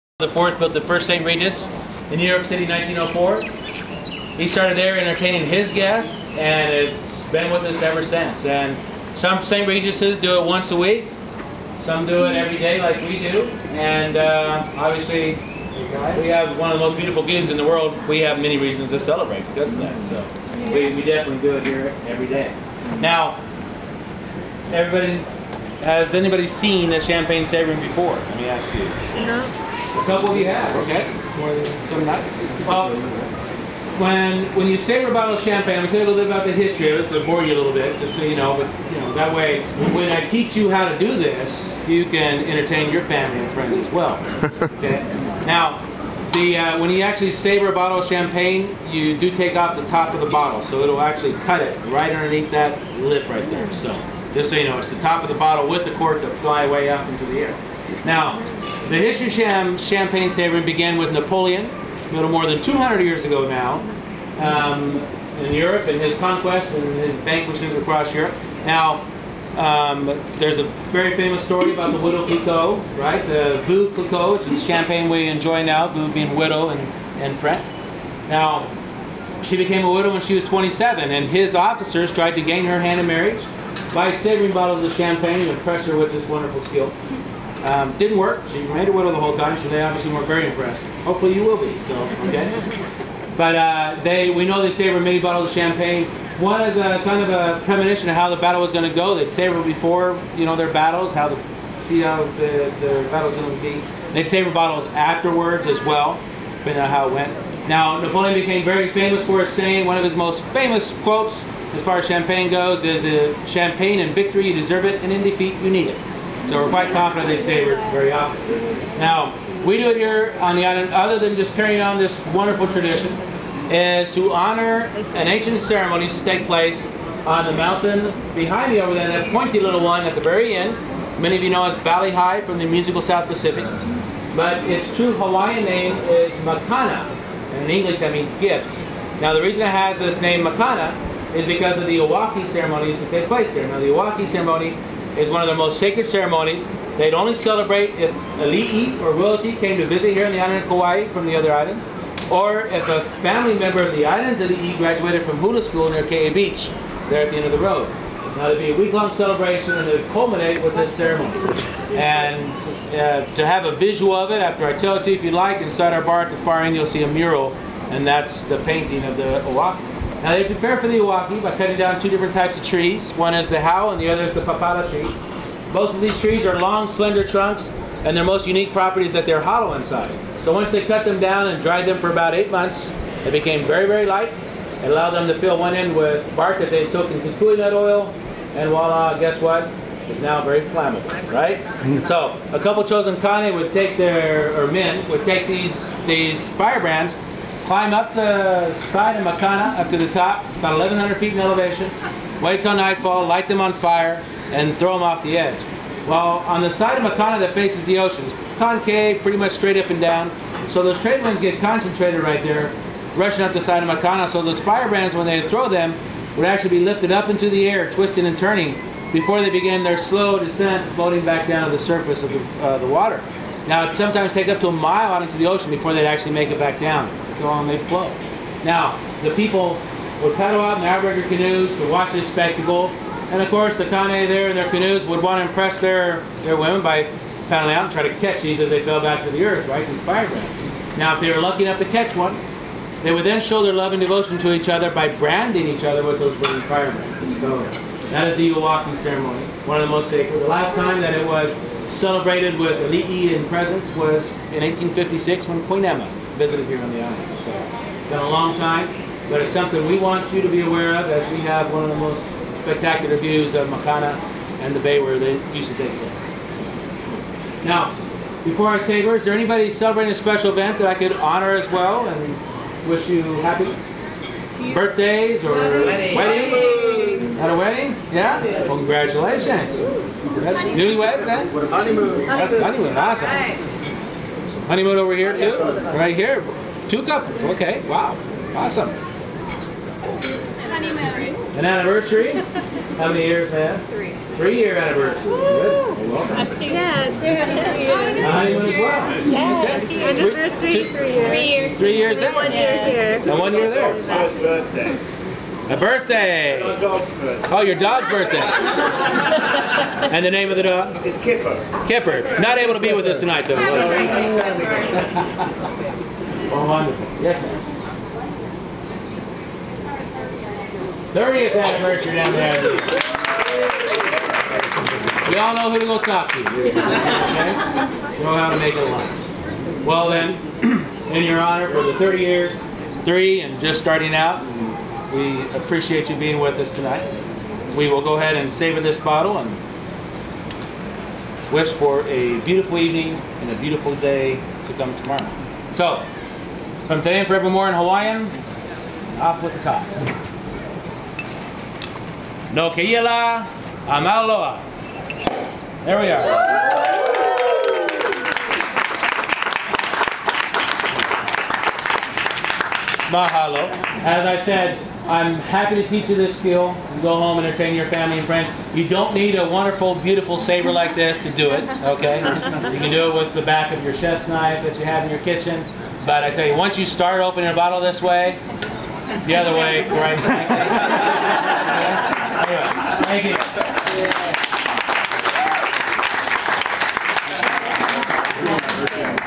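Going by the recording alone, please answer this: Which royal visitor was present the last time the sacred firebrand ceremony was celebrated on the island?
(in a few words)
Queen Emma.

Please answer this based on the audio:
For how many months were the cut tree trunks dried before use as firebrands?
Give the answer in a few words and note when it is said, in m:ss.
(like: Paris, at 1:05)
8, at 3:02.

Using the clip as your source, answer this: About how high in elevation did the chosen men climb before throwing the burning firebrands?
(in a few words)
1,100 feet.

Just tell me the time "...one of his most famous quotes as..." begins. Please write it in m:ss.
1:49.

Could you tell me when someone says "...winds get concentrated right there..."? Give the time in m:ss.
3:31.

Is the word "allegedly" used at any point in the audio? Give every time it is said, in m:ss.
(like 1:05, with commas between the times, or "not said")
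not said.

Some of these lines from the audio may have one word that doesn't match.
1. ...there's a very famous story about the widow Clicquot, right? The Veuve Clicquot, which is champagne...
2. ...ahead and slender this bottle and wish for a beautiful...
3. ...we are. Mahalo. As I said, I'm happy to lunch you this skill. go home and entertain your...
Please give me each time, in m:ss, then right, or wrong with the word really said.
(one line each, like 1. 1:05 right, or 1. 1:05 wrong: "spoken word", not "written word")
1. 1:10 right
2. 5:38 wrong: "saber", not "slender"
3. 5:55 wrong: "teach", not "lunch".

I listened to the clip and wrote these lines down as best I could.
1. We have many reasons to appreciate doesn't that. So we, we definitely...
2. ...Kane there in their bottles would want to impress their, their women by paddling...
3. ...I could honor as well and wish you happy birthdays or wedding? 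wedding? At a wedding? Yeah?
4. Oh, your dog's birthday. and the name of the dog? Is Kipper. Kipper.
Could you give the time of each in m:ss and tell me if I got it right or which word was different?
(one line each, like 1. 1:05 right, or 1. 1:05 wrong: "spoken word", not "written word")
1. 0:18 wrong: "celebrate", not "appreciate"
2. 3:53 wrong: "canoes", not "bottles"
3. 4:30 right
4. 5:07 right.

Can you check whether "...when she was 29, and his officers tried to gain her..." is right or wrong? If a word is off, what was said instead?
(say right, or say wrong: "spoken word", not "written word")
wrong: "27", not "29".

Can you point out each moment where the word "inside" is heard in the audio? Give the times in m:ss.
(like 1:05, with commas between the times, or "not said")
2:45, 2:59.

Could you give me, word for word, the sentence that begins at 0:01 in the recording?
Regis in New York City, 1904.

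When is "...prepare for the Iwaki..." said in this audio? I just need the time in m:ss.
2:50.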